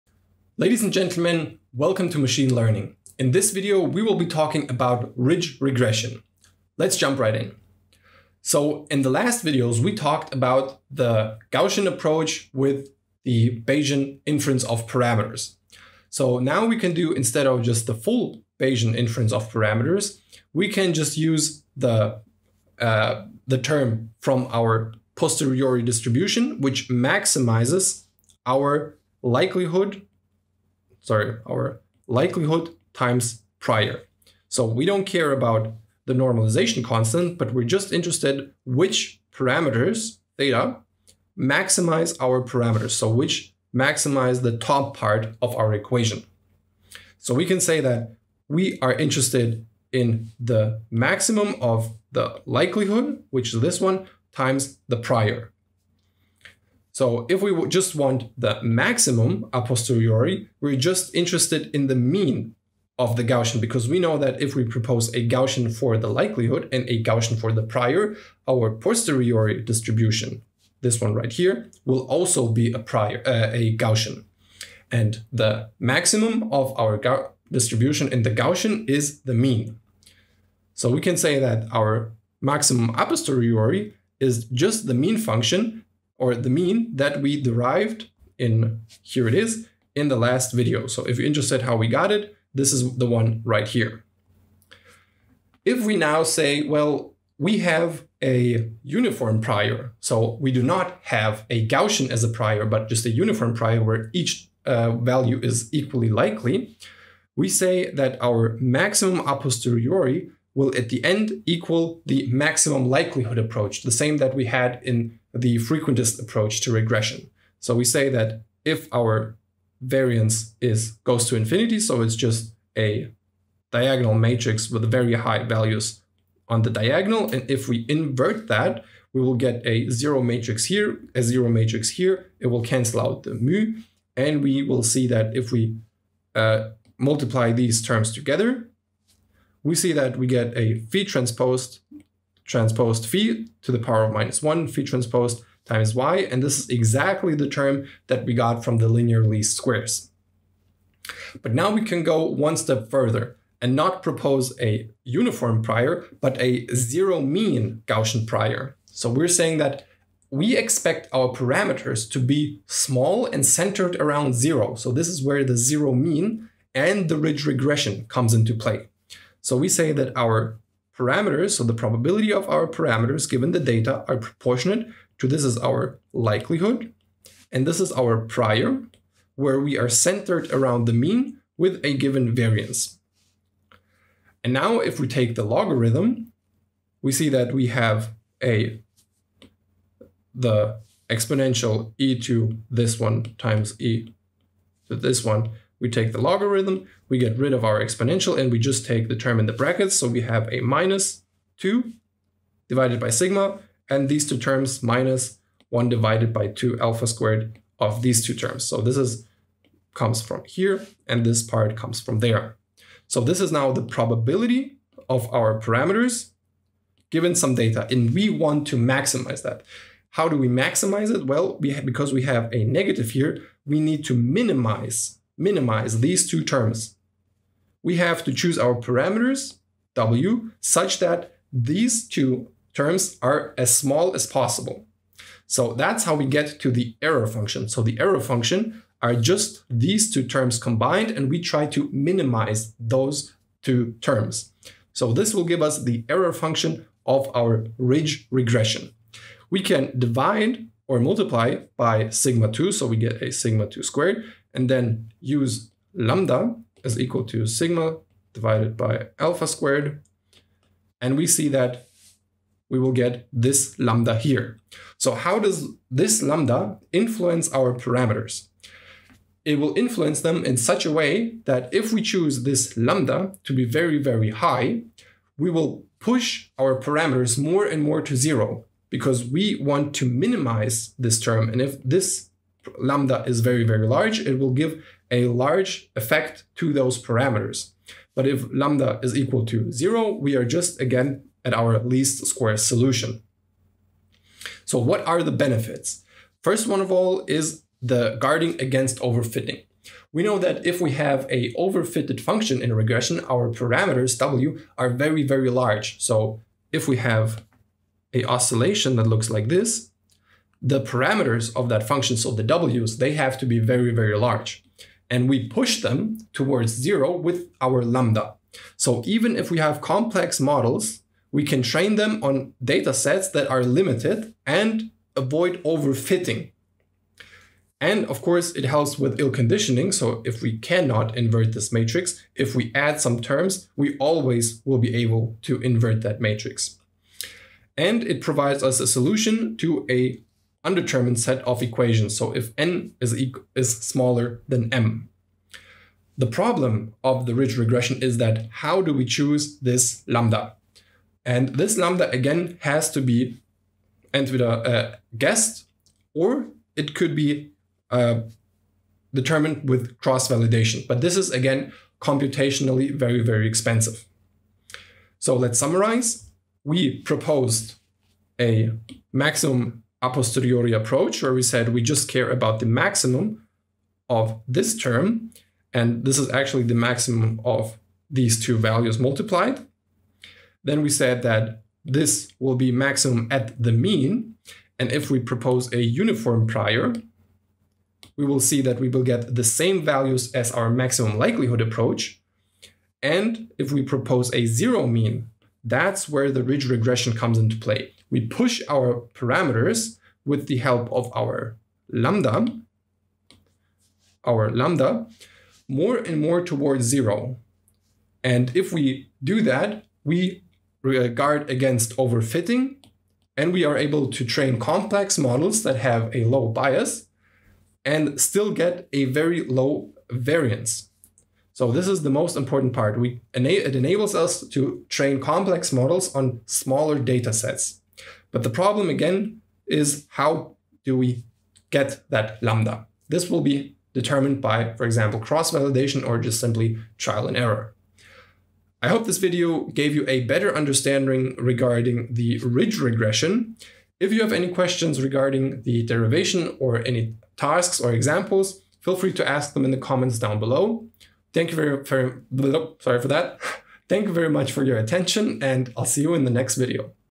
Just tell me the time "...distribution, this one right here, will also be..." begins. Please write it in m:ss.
1:09.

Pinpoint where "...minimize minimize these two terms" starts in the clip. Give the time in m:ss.
3:44.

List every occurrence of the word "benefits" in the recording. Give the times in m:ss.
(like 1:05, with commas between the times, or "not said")
4:55.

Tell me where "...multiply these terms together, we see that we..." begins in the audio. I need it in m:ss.
2:16.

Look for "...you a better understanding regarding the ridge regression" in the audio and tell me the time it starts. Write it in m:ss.
7:19.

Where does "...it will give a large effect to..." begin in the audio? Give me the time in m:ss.
4:44.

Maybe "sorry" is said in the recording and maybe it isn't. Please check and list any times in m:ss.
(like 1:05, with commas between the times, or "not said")
0:31, 7:32.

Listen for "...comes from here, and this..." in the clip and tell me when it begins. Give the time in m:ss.
3:29.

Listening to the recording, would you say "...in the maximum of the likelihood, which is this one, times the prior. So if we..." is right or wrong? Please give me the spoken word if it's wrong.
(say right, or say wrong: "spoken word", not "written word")
right.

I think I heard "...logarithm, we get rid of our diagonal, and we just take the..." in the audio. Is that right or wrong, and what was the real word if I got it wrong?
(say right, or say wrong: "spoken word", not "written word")
wrong: "exponential", not "diagonal".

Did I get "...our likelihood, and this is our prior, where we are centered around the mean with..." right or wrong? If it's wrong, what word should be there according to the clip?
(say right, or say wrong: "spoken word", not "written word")
right.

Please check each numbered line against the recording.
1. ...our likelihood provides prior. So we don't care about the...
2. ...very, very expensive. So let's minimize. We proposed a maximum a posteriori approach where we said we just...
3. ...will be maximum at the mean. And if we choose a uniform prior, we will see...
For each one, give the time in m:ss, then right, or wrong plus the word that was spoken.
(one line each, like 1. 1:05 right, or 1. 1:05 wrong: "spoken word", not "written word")
1. 0:31 wrong: "times", not "provides"
2. 6:02 wrong: "summarize", not "minimize"
3. 6:22 wrong: "propose", not "choose".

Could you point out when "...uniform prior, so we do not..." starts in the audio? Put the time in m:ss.
1:38.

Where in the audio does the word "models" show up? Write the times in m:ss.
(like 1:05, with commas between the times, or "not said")
5:20, 6:55, 7:05.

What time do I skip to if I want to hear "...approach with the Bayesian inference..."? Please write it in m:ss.
0:11.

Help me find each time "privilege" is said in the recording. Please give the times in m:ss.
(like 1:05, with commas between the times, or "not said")
not said.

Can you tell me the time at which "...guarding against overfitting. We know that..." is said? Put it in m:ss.
4:58.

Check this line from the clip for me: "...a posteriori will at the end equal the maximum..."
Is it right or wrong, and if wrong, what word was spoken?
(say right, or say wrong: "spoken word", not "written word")
right.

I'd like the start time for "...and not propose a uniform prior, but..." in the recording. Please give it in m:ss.
2:33.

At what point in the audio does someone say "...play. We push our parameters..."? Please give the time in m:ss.
6:37.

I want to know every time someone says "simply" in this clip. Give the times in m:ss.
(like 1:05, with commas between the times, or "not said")
7:16.